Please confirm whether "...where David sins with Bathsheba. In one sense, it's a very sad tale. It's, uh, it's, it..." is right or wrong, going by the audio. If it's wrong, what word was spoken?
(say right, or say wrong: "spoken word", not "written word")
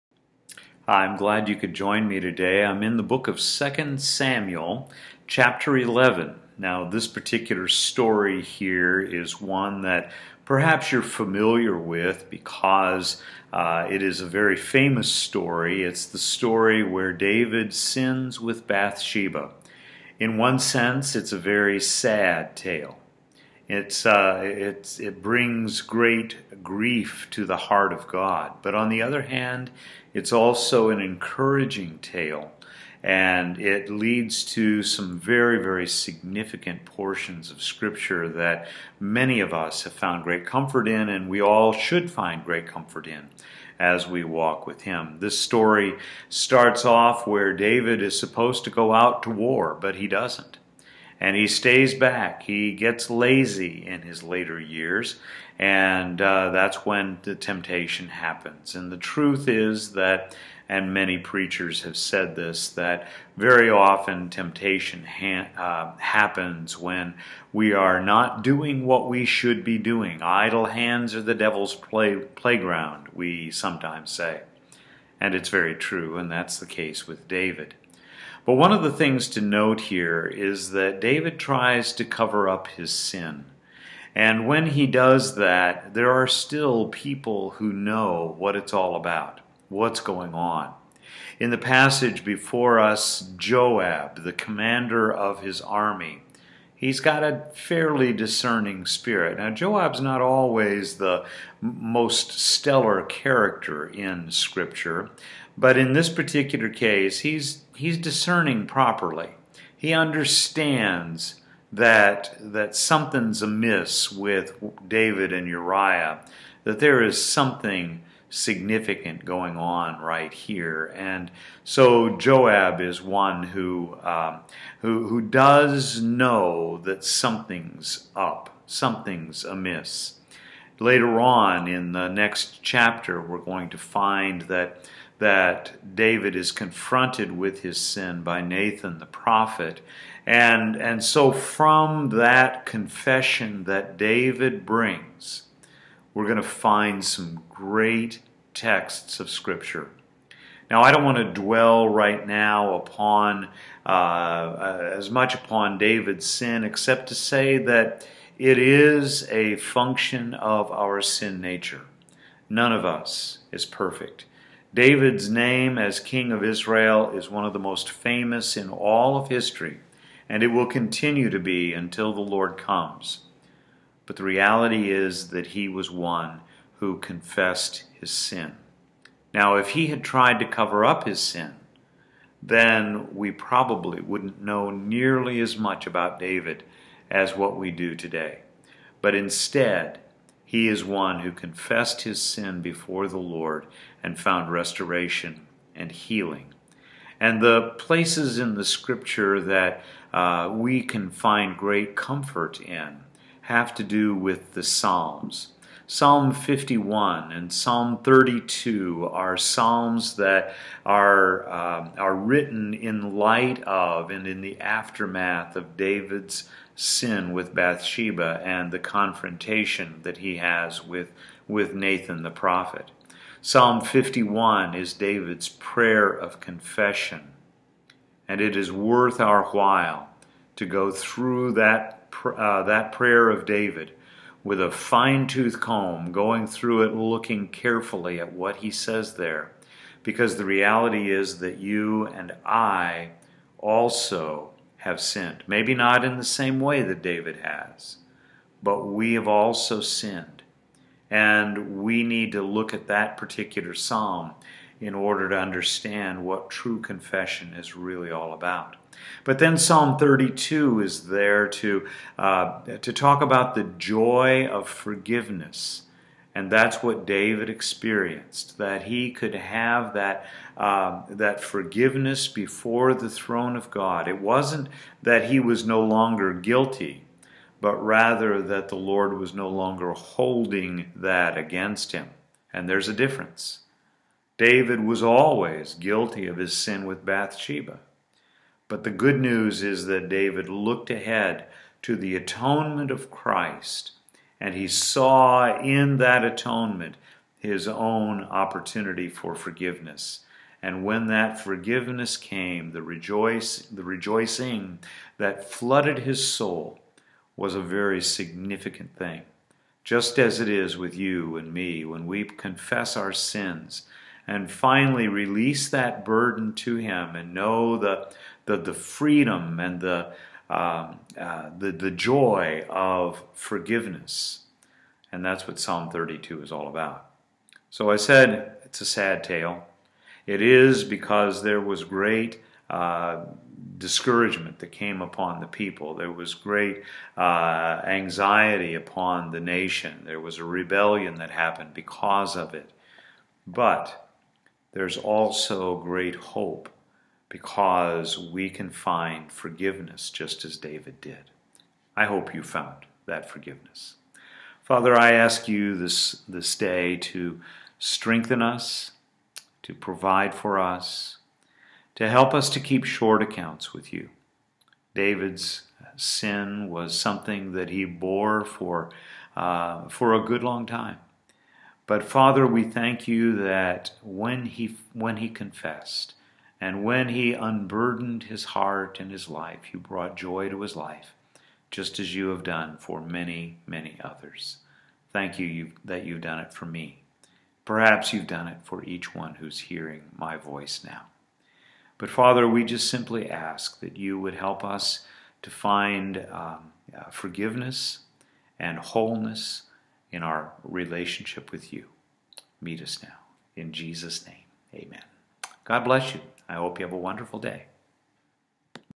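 right.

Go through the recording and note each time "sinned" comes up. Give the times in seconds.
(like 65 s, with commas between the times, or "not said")
244 s, 249 s.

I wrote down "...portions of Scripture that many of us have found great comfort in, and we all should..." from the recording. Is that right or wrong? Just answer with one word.
right.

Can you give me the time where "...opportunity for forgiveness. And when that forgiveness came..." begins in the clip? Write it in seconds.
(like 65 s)
298 s.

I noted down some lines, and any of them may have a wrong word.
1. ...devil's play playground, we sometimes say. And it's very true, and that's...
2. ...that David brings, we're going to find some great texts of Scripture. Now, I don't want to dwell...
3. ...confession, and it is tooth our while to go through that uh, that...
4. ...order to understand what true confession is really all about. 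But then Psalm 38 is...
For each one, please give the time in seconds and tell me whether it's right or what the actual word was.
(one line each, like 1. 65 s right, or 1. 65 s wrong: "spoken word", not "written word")
1. 71 s right
2. 143 s right
3. 226 s wrong: "worth", not "tooth"
4. 254 s wrong: "32", not "38".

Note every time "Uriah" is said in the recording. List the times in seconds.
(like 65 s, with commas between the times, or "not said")
115 s.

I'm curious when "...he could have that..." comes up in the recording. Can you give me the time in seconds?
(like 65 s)
268 s.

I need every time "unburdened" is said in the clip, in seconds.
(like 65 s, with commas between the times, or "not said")
377 s.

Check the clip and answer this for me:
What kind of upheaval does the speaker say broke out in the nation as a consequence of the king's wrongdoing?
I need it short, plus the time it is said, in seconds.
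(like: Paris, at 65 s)
A rebellion, at 340 s.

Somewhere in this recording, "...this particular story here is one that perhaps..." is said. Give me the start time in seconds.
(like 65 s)
6 s.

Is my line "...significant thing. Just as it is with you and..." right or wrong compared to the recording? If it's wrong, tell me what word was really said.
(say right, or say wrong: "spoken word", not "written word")
right.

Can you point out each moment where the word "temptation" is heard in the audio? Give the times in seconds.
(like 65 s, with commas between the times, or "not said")
57 s, 64 s.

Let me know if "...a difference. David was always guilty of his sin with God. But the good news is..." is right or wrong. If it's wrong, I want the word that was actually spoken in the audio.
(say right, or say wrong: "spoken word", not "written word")
wrong: "Bathsheba", not "God".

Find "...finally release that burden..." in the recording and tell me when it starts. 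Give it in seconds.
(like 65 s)
314 s.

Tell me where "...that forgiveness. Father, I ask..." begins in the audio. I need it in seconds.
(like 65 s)
353 s.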